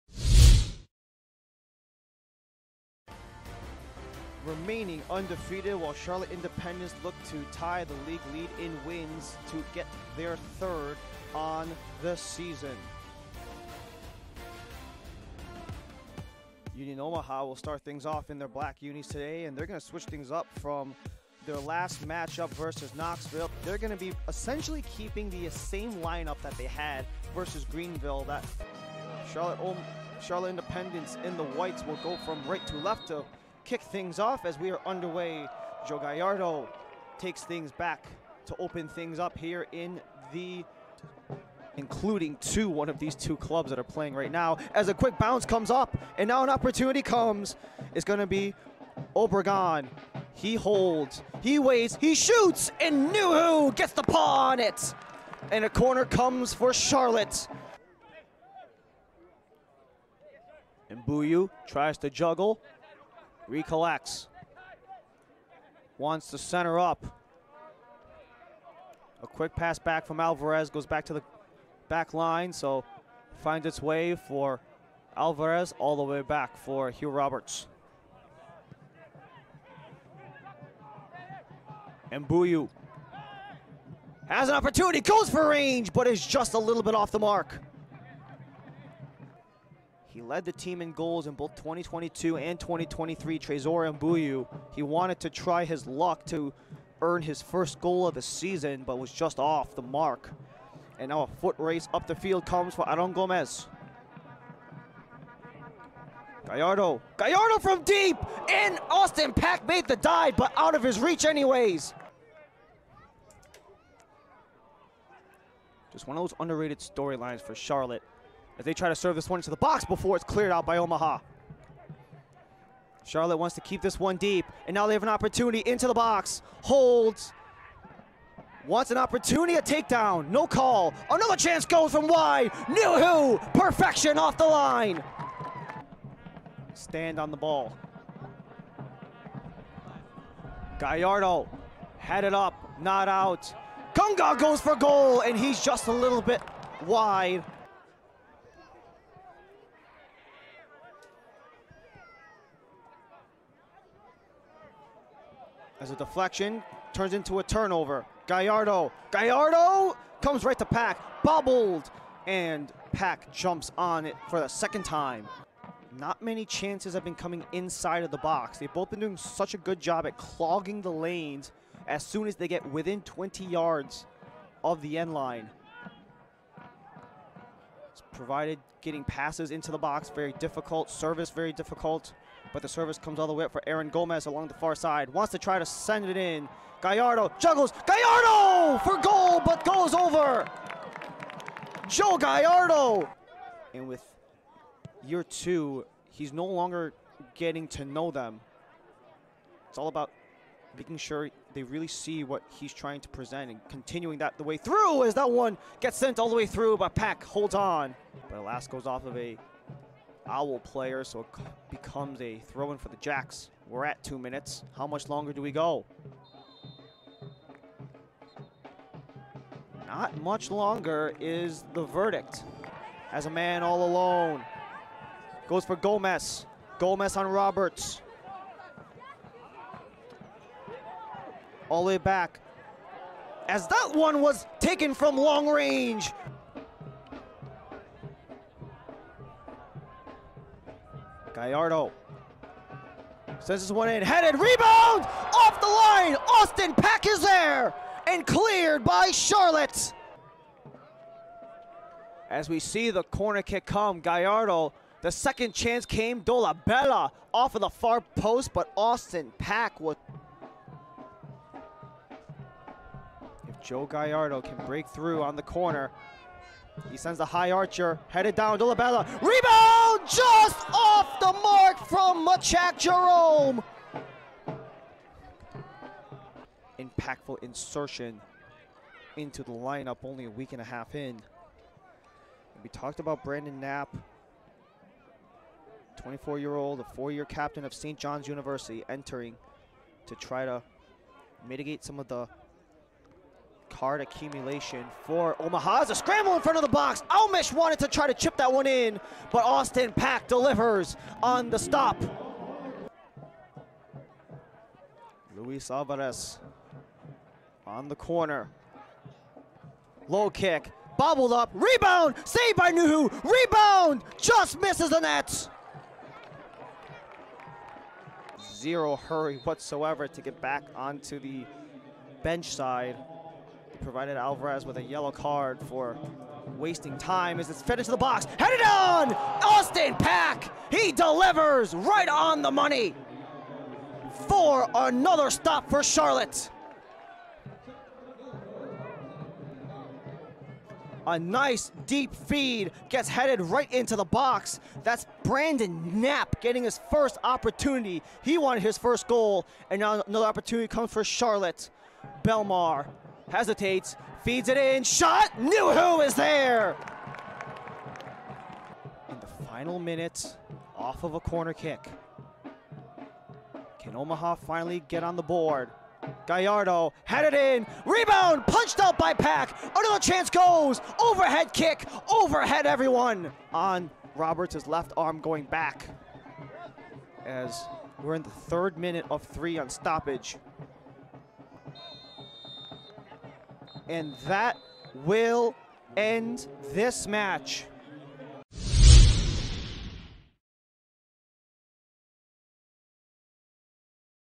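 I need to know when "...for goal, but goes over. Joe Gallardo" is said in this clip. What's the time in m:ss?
3:08.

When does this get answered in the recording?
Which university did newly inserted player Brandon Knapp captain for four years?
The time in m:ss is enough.
4:47.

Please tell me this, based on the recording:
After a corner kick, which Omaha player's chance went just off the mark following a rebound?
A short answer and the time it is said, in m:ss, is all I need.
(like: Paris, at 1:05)
Machak Jerome, at 4:32.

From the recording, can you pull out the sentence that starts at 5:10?
Low kick, bobbled up, rebound, saved by Nuhu, rebound, just misses the net.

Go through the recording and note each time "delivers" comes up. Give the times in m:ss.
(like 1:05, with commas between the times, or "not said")
5:00, 5:30.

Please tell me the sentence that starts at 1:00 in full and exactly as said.
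And Mbuyu tries to juggle, Recollects.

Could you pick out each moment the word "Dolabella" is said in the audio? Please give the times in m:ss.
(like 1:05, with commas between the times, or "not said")
4:16, 4:28.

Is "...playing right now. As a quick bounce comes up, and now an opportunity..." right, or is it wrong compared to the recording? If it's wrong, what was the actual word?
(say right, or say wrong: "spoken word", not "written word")
right.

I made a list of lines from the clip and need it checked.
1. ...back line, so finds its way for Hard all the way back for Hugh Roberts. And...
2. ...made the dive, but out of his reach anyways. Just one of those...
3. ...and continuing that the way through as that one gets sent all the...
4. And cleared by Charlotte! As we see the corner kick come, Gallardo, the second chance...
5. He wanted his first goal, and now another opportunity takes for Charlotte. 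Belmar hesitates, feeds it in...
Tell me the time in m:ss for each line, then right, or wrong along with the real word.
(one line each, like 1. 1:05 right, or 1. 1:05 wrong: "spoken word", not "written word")
1. 1:11 wrong: "Alvarez", not "Hard"
2. 1:49 right
3. 3:23 right
4. 4:08 right
5. 5:48 wrong: "comes", not "takes".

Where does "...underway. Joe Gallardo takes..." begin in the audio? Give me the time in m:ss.
0:34.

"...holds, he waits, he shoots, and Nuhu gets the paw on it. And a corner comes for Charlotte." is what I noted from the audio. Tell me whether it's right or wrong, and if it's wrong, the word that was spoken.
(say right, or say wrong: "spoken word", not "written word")
right.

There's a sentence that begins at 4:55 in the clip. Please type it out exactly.
It's a scramble in front of the box.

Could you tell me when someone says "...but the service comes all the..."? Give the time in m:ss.
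3:02.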